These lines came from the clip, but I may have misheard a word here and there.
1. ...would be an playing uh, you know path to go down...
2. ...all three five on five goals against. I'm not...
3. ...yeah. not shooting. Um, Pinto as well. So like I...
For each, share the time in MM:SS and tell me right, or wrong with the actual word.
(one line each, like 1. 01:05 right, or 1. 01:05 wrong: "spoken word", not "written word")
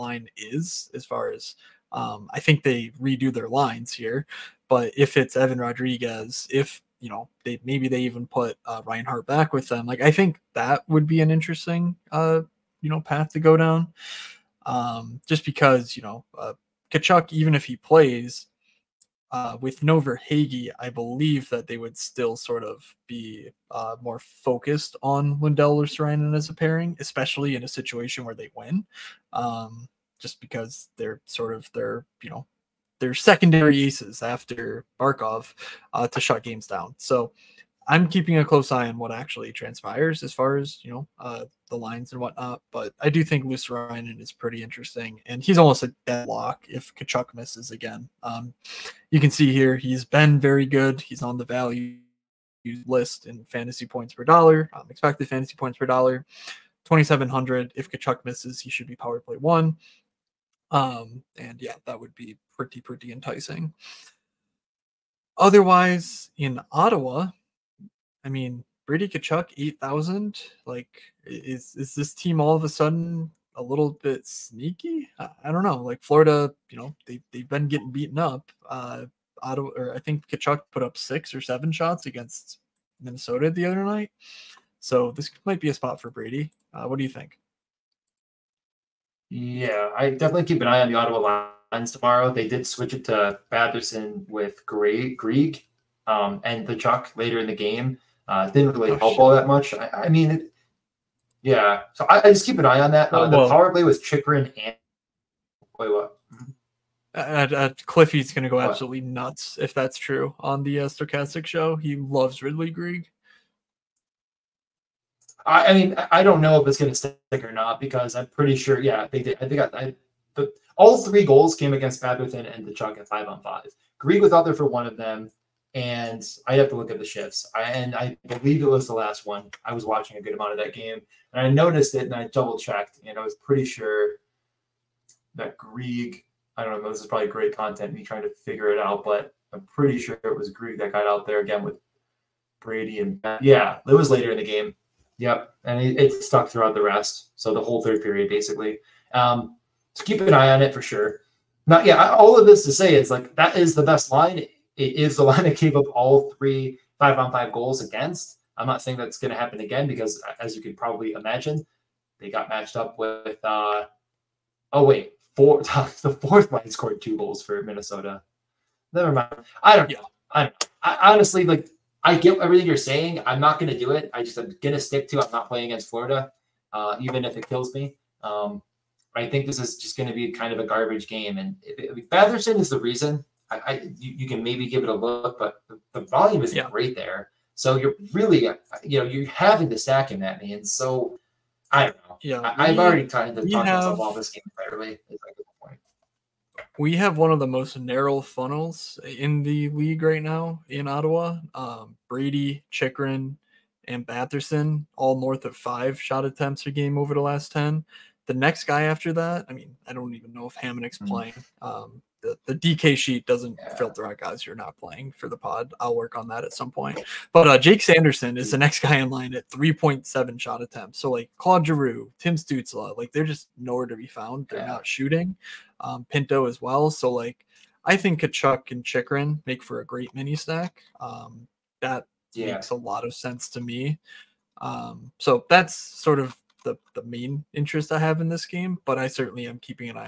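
1. 00:10 wrong: "interesting", not "playing"
2. 02:35 right
3. 03:44 right.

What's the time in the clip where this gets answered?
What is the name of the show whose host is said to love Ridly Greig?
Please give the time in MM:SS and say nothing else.
01:50.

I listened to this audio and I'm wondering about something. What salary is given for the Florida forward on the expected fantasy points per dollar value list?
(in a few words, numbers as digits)
2,700.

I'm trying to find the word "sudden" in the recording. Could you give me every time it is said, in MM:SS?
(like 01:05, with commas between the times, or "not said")
01:12.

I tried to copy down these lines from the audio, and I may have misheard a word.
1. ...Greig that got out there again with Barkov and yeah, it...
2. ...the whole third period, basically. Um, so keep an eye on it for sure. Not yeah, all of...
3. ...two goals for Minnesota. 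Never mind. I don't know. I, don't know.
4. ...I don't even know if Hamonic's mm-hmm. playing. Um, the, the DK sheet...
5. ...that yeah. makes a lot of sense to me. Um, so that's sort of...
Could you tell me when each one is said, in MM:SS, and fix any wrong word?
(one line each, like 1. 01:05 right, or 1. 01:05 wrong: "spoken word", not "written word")
1. 02:20 wrong: "Brady", not "Barkov"
2. 02:27 right
3. 02:47 right
4. 03:29 right
5. 03:51 right.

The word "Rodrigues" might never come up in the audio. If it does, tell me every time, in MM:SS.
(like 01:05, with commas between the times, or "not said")
00:05.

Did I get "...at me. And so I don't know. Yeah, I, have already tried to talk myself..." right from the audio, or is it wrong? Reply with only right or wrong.
right.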